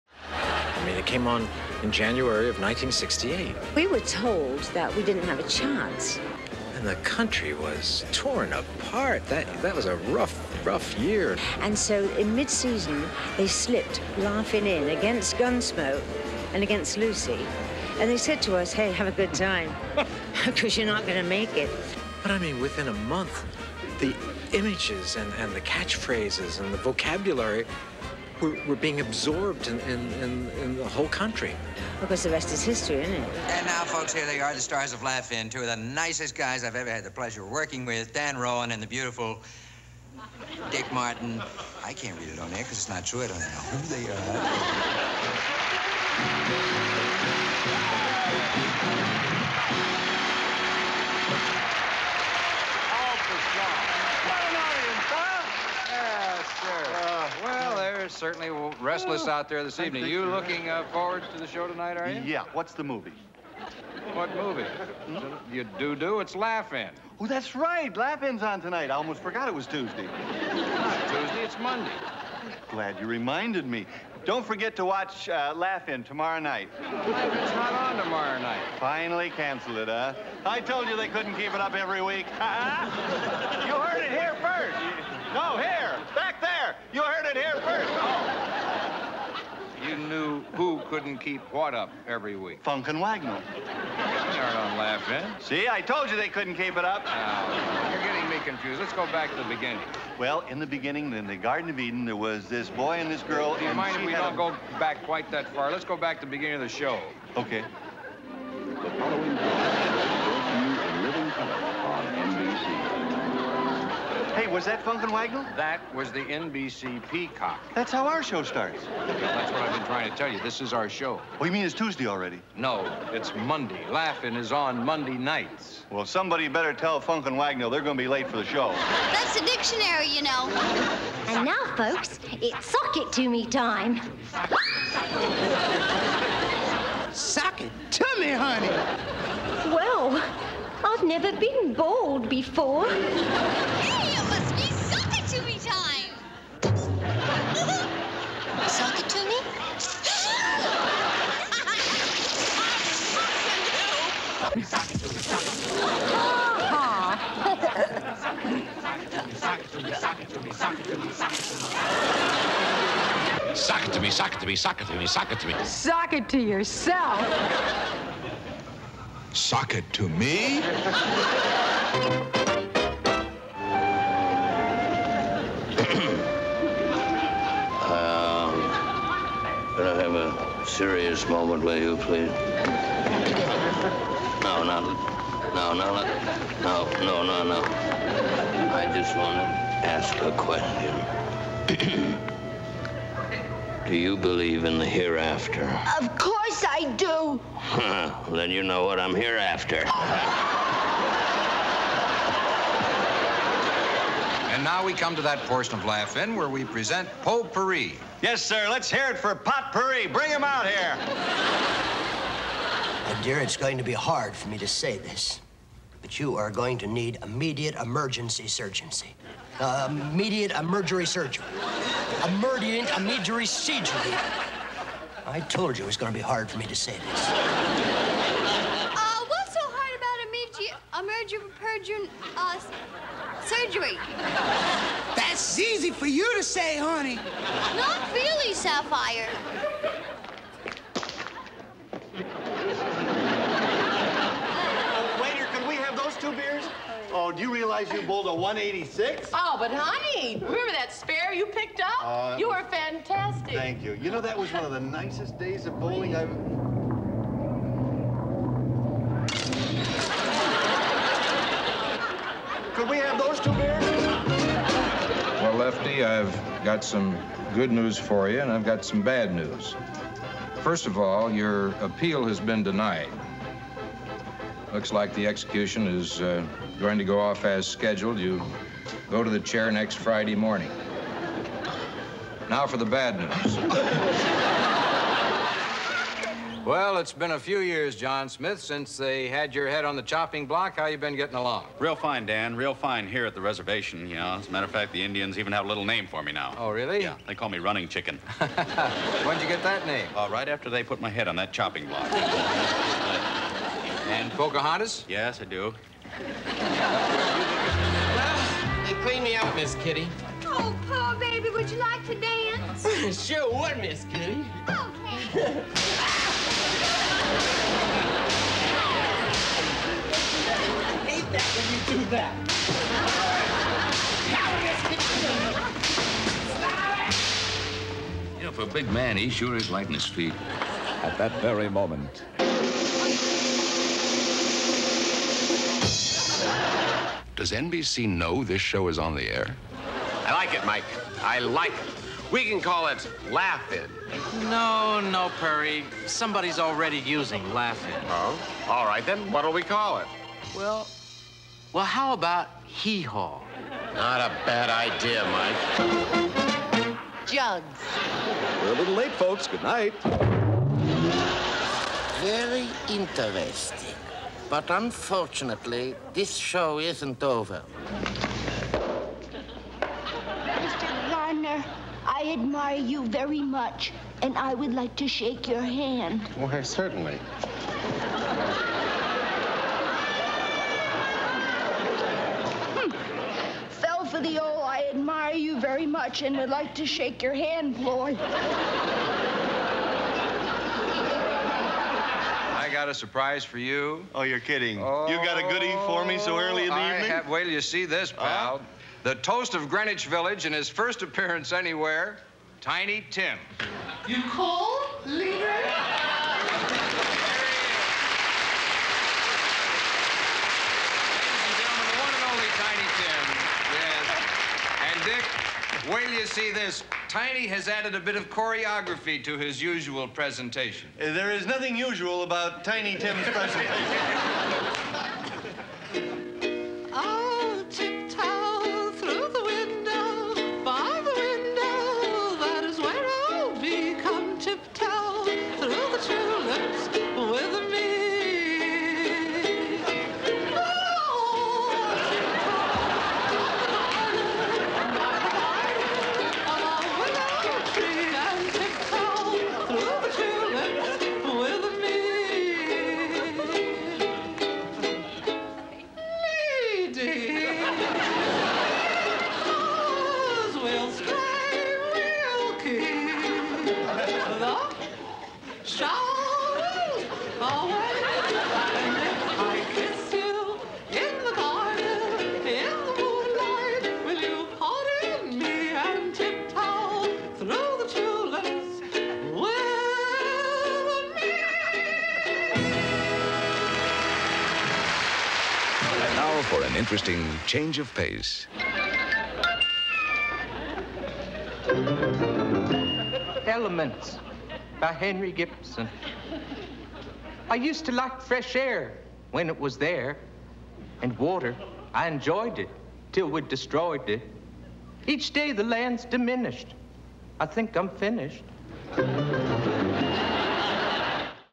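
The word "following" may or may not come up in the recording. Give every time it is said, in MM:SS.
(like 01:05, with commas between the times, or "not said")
01:48.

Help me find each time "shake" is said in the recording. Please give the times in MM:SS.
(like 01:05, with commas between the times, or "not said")
06:15, 06:26.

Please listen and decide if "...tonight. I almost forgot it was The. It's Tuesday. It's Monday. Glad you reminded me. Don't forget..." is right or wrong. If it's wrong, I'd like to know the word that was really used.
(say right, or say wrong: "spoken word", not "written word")
wrong: "Tuesday", not "The".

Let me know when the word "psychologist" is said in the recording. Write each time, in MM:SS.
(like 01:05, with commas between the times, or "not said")
not said.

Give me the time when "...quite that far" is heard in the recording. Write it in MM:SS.
01:45.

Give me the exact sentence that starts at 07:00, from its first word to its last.
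There is nothing usual about Tiny Tim's presentation.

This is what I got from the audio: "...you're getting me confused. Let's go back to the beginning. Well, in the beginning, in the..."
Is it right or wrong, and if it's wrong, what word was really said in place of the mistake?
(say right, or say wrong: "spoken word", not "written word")
right.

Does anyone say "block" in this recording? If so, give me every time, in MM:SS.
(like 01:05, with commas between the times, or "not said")
04:50, 05:01.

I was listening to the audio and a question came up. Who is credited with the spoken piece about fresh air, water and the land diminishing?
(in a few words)
Henry Gibson.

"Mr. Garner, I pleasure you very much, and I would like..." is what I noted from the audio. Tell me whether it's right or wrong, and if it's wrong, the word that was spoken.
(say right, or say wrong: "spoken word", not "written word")
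wrong: "admire", not "pleasure".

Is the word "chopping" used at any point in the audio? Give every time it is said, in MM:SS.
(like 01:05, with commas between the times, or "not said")
04:50, 05:01.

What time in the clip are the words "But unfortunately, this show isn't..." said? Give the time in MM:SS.
06:04.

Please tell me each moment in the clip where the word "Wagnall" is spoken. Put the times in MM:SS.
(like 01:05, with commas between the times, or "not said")
01:32, 01:55, 02:07.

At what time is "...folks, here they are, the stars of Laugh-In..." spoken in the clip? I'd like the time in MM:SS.
00:33.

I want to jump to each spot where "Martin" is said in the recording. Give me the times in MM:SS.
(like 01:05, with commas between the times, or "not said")
00:40.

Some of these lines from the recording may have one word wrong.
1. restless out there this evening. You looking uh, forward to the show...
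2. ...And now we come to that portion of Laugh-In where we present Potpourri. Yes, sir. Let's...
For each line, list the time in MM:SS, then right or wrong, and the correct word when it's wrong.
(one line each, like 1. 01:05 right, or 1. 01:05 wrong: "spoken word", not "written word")
1. 00:58 right
2. 03:24 right.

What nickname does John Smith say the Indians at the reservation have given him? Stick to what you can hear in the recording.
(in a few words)
Running Chicken.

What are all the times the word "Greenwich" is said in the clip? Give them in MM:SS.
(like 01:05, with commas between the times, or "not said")
06:39.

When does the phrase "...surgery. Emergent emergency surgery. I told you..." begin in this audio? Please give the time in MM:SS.
03:41.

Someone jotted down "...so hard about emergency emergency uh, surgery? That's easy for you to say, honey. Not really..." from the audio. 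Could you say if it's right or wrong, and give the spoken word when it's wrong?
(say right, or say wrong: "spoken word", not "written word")
right.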